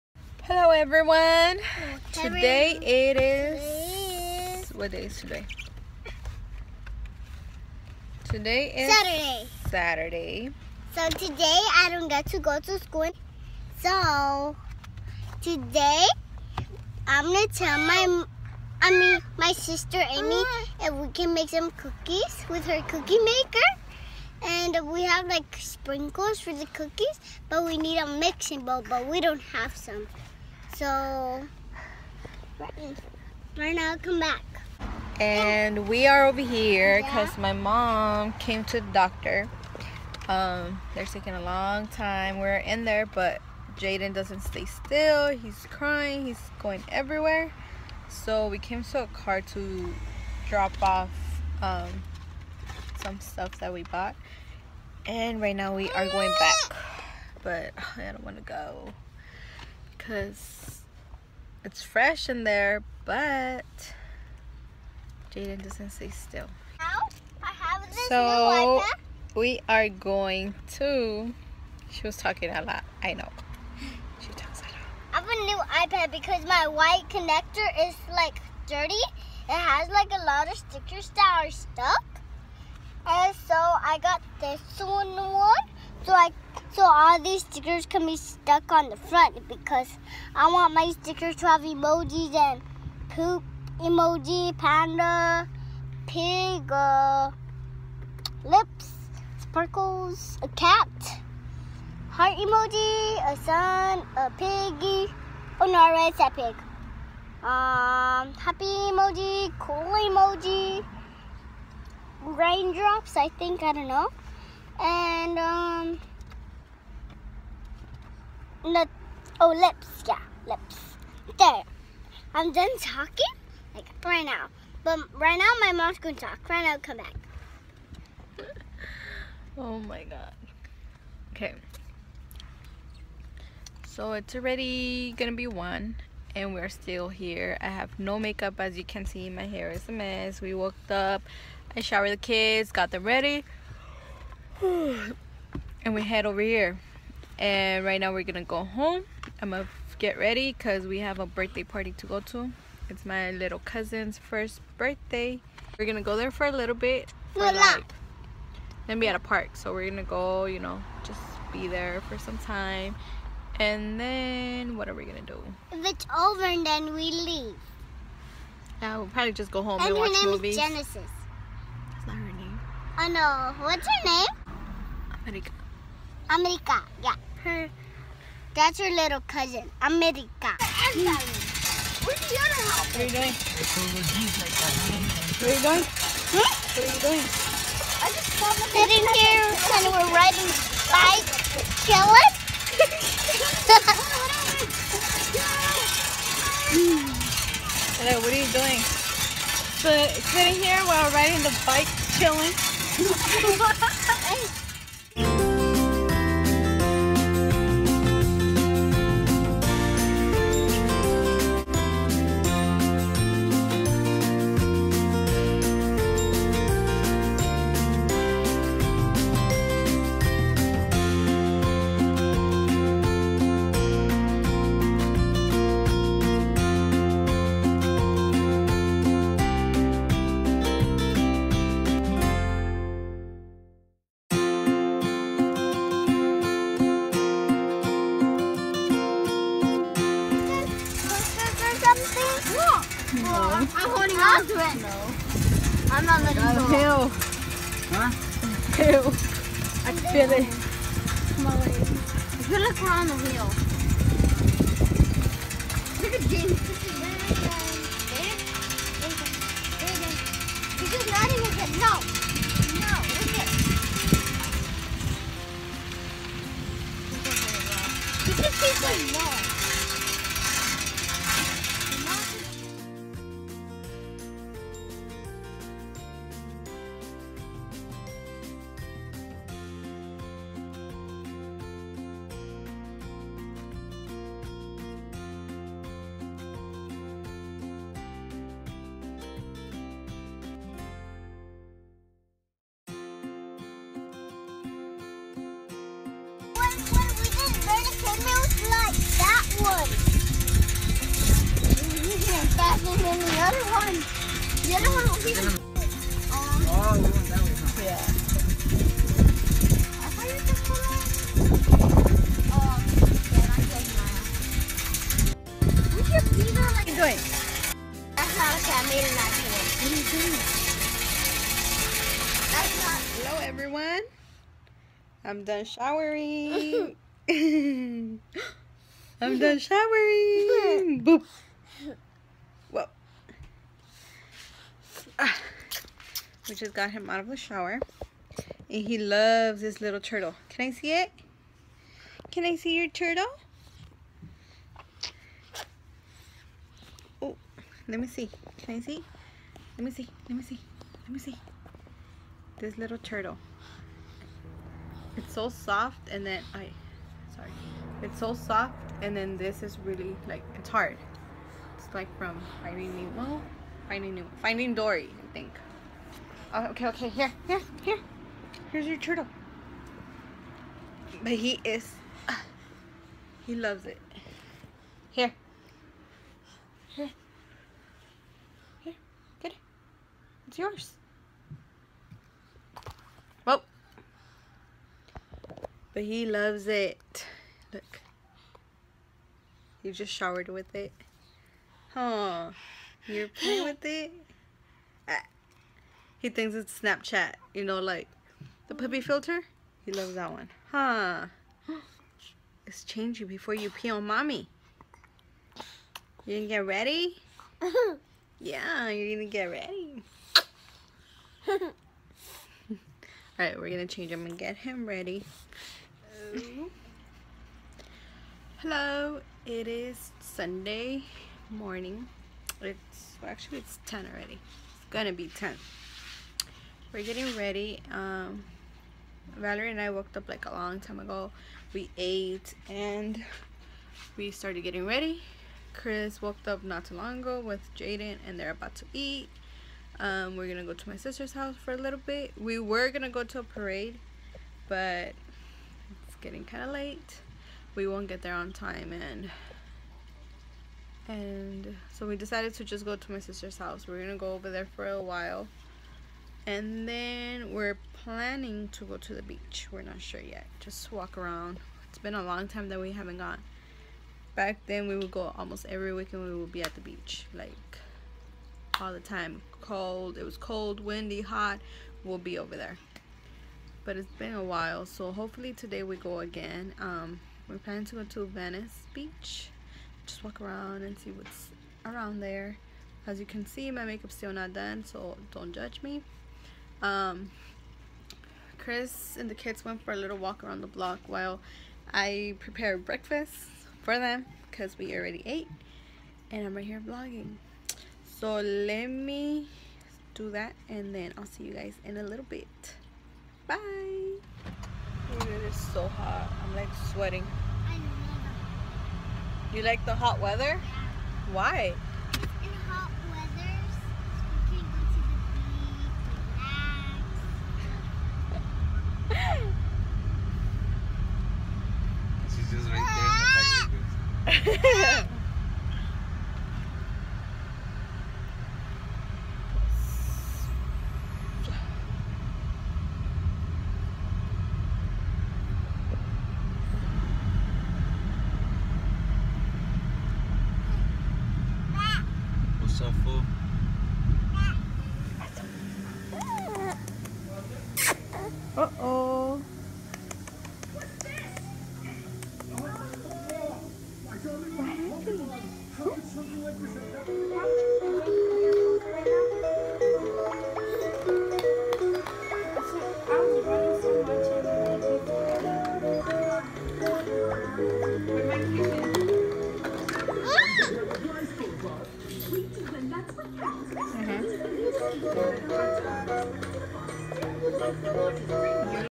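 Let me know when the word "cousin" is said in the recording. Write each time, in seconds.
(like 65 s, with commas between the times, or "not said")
153 s, 179 s.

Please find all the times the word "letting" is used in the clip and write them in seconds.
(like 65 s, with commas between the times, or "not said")
246 s, 261 s.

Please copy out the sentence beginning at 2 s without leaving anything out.
Today it is what day is today?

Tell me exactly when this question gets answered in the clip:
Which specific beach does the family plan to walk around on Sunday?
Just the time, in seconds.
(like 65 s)
478 s.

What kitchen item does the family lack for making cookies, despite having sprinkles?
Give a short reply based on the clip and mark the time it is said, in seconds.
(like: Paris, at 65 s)
mixing bowl, at 28 s.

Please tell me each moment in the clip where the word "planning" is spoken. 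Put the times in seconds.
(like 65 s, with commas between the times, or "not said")
457 s, 477 s.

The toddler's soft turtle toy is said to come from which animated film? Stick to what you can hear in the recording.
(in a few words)
Finding Dory.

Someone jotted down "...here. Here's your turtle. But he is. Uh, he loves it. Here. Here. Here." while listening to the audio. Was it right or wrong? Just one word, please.
right.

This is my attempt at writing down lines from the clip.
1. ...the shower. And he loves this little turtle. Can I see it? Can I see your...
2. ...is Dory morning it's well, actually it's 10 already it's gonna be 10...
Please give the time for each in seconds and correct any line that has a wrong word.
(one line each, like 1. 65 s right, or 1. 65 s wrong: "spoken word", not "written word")
1. 337 s right
2. 419 s wrong: "Sunday", not "Dory".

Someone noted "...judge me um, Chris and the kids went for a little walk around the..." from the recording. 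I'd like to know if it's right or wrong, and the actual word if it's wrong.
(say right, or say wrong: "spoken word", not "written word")
right.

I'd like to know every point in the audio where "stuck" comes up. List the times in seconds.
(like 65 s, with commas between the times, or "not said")
81 s, 88 s.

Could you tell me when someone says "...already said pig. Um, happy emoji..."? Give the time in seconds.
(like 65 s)
105 s.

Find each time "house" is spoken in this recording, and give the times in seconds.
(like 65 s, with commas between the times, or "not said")
441 s, 453 s.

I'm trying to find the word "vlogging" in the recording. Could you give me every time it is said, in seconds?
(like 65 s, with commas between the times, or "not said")
496 s.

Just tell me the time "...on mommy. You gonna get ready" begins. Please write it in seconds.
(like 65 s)
403 s.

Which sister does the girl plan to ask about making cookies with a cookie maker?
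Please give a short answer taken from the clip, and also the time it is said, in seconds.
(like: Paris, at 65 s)
Amy, at 20 s.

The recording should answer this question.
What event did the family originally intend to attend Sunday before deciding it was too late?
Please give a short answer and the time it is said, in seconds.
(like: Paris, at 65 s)
a parade, at 443 s.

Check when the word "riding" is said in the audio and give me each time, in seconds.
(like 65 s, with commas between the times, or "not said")
190 s, 201 s.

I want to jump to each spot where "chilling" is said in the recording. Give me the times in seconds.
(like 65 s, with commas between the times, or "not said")
191 s, 202 s.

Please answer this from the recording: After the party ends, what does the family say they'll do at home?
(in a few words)
watch movies.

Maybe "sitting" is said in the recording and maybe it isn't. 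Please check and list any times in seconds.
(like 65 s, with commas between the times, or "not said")
188 s, 200 s.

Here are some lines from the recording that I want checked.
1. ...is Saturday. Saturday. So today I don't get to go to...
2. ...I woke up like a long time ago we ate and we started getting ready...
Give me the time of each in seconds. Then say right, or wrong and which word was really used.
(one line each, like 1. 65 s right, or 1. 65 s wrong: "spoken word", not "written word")
1. 8 s right
2. 429 s right.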